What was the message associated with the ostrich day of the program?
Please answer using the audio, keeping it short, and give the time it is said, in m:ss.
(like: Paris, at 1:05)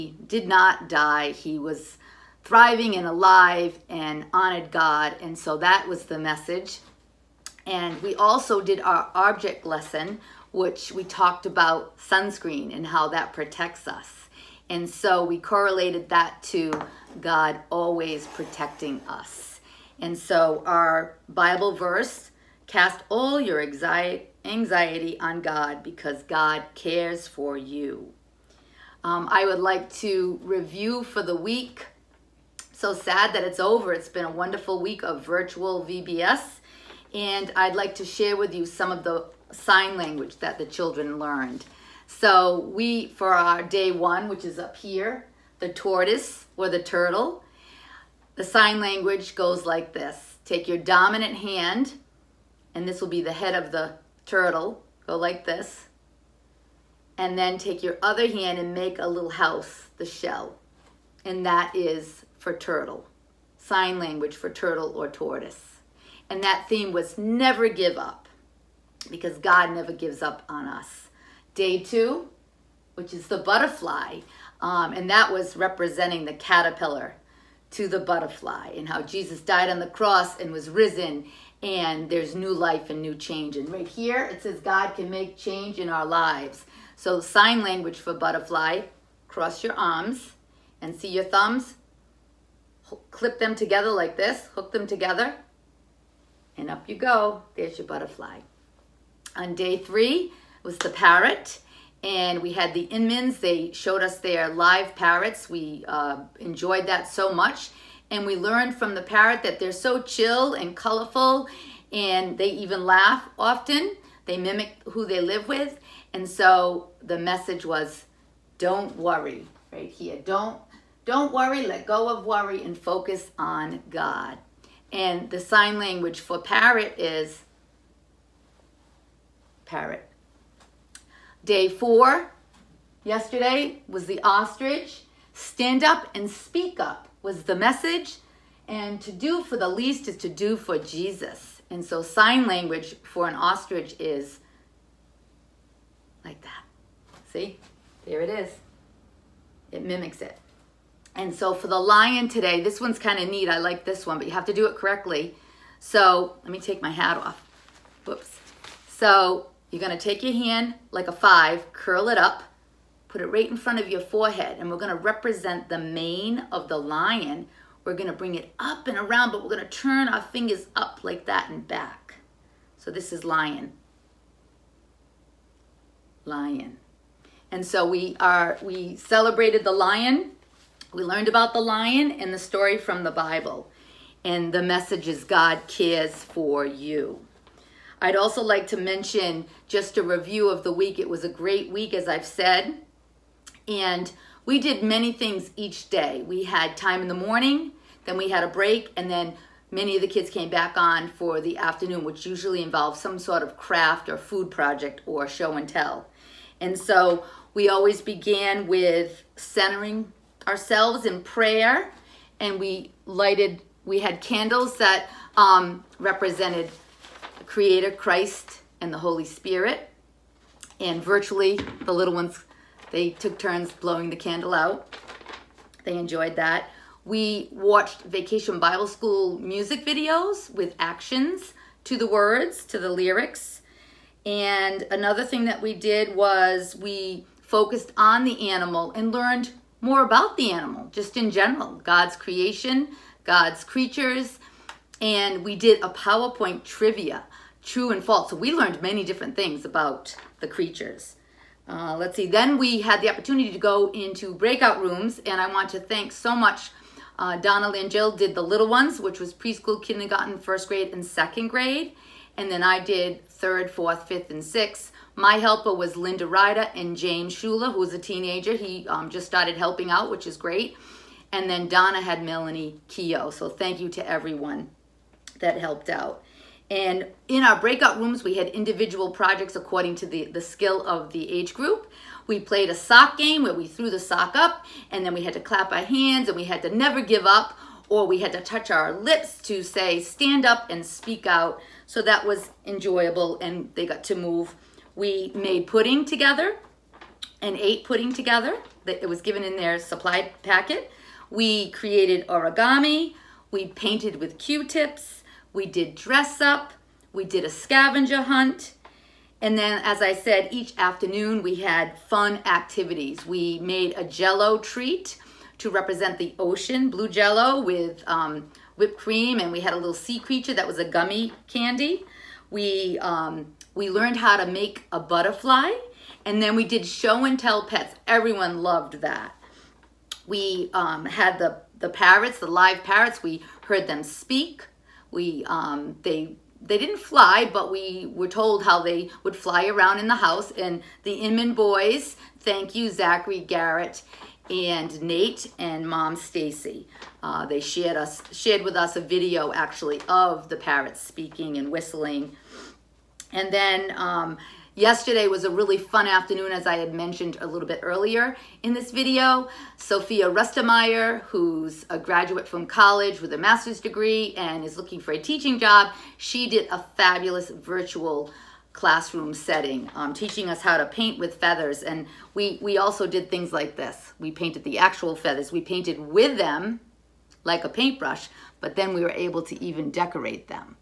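Stand up and speak up, at 2:15.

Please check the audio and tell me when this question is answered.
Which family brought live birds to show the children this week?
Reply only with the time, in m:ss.
1:42.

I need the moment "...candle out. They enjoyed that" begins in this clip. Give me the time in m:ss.
3:44.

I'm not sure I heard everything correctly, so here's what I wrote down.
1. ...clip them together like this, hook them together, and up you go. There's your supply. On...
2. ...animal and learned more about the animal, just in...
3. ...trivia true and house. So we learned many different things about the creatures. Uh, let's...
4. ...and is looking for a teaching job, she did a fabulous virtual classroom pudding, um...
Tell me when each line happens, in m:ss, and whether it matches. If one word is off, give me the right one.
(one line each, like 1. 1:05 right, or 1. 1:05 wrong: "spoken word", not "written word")
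1. 1:33 wrong: "butterfly", not "supply"
2. 3:58 right
3. 4:06 wrong: "false", not "house"
4. 6:04 wrong: "setting", not "pudding".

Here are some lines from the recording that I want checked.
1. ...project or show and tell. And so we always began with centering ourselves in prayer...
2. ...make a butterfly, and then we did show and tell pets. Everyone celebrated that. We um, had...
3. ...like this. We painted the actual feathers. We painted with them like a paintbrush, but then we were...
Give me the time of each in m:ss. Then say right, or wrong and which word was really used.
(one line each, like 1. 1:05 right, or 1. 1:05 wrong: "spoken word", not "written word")
1. 3:24 right
2. 5:24 wrong: "loved", not "celebrated"
3. 6:13 right.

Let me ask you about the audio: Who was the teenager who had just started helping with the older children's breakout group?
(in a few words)
James Schuler.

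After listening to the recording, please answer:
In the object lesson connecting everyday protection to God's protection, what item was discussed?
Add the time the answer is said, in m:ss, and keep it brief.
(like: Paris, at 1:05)
Sunscreen, at 0:11.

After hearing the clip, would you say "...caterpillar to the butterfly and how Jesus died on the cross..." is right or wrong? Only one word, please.
right.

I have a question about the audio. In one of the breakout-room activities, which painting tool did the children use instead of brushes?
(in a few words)
Q-tips.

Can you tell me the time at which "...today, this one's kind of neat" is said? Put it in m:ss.
2:32.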